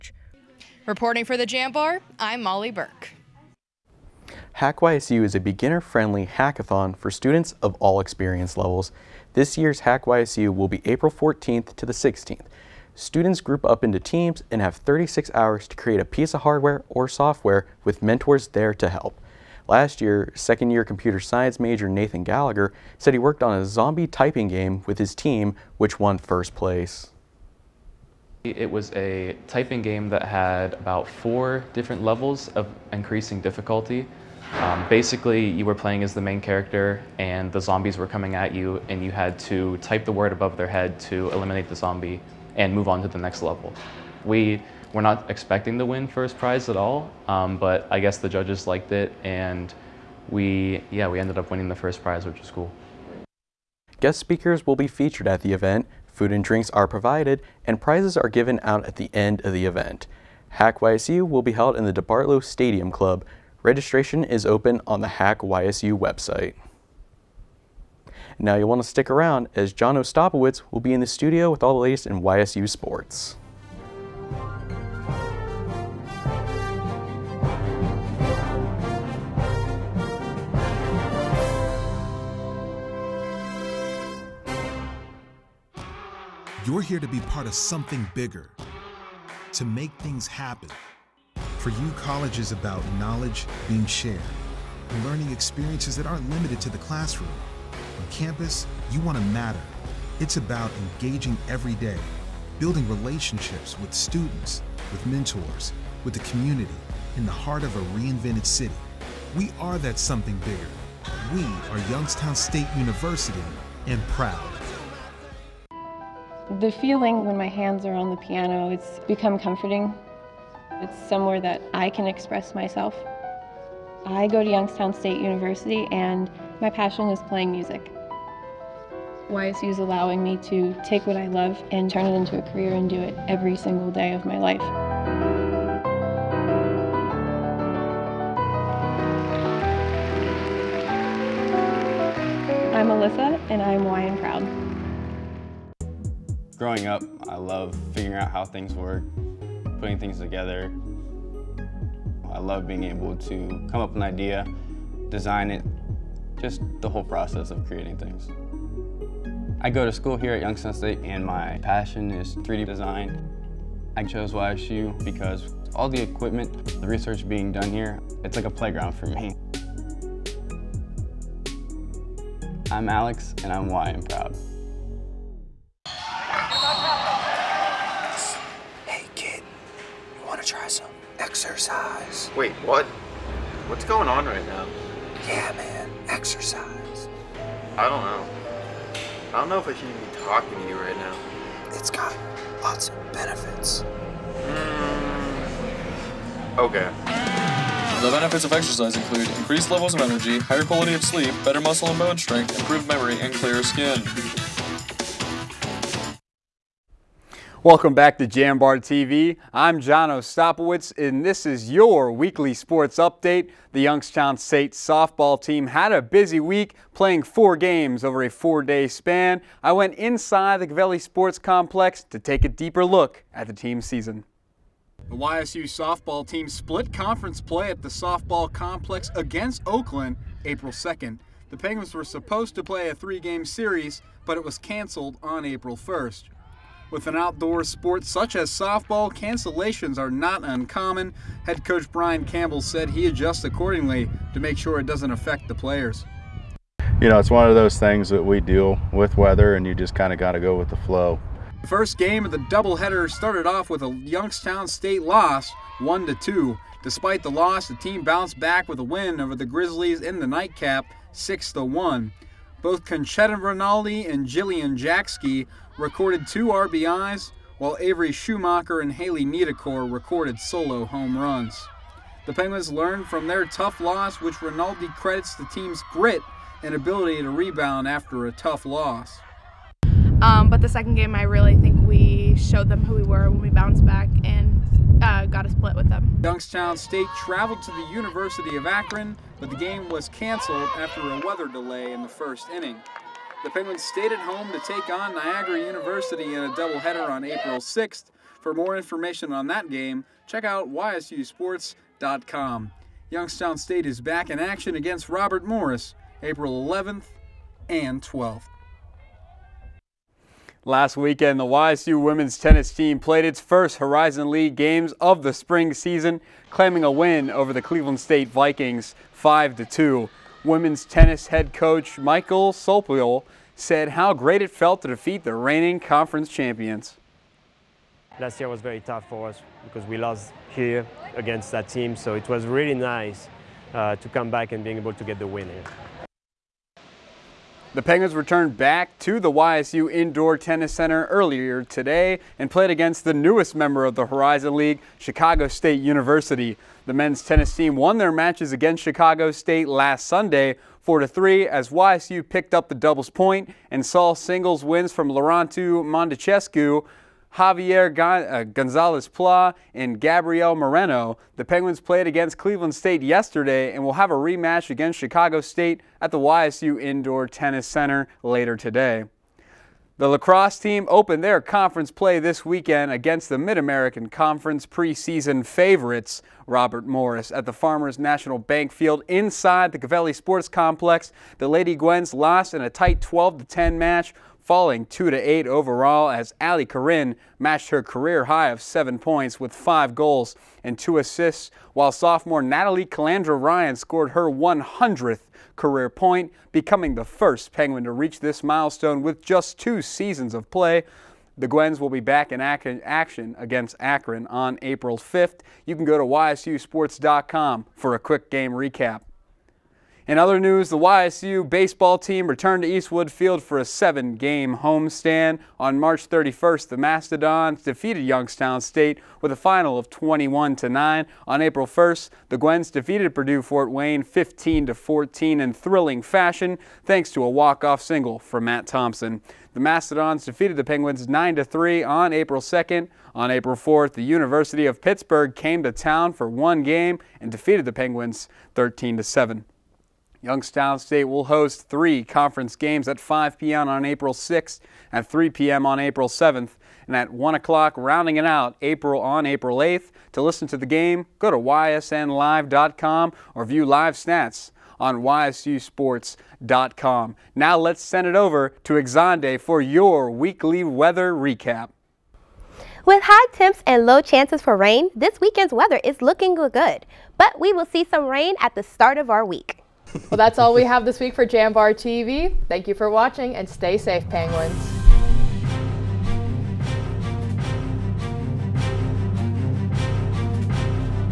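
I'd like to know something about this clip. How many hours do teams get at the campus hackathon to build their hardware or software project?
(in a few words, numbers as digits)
36.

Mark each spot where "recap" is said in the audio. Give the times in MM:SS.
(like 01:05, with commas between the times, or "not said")
06:48, 07:41.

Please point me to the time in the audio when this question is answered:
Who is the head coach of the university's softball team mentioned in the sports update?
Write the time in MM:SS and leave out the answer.
04:01.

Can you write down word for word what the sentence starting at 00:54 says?
Guest speakers will be featured at the event.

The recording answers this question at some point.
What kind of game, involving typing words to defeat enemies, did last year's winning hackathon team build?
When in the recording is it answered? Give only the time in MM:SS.
00:23.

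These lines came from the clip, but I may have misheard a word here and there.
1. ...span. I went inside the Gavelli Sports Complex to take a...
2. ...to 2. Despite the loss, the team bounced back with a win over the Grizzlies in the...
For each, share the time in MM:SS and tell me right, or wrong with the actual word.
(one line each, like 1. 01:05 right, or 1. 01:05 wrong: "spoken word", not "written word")
1. 03:38 right
2. 04:16 right.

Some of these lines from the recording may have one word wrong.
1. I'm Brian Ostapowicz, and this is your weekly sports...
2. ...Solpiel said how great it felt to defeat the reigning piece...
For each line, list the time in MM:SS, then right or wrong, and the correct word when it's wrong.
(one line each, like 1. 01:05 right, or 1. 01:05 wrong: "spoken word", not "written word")
1. 03:29 wrong: "John", not "Brian"
2. 05:22 wrong: "conference", not "piece".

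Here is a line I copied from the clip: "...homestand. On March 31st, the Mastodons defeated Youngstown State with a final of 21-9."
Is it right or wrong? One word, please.
right.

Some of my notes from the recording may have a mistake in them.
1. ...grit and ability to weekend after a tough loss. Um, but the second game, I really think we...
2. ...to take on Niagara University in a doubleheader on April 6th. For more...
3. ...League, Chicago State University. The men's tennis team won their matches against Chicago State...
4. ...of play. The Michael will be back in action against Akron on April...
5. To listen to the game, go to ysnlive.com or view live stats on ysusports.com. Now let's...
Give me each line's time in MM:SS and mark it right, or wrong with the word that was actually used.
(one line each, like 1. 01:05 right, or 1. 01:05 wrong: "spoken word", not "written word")
1. 04:35 wrong: "rebound", not "weekend"
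2. 04:54 right
3. 05:44 right
4. 06:40 wrong: "Guins", not "Michael"
5. 07:30 right.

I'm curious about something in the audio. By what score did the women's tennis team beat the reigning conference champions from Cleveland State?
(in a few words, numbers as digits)
5-2.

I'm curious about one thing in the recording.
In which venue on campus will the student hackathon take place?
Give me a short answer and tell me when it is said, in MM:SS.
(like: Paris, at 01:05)
DeBartolo Stadium Club, at 01:01.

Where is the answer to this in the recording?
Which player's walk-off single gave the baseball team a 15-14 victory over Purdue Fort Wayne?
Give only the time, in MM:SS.
07:08.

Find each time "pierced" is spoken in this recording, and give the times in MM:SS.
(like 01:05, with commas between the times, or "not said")
not said.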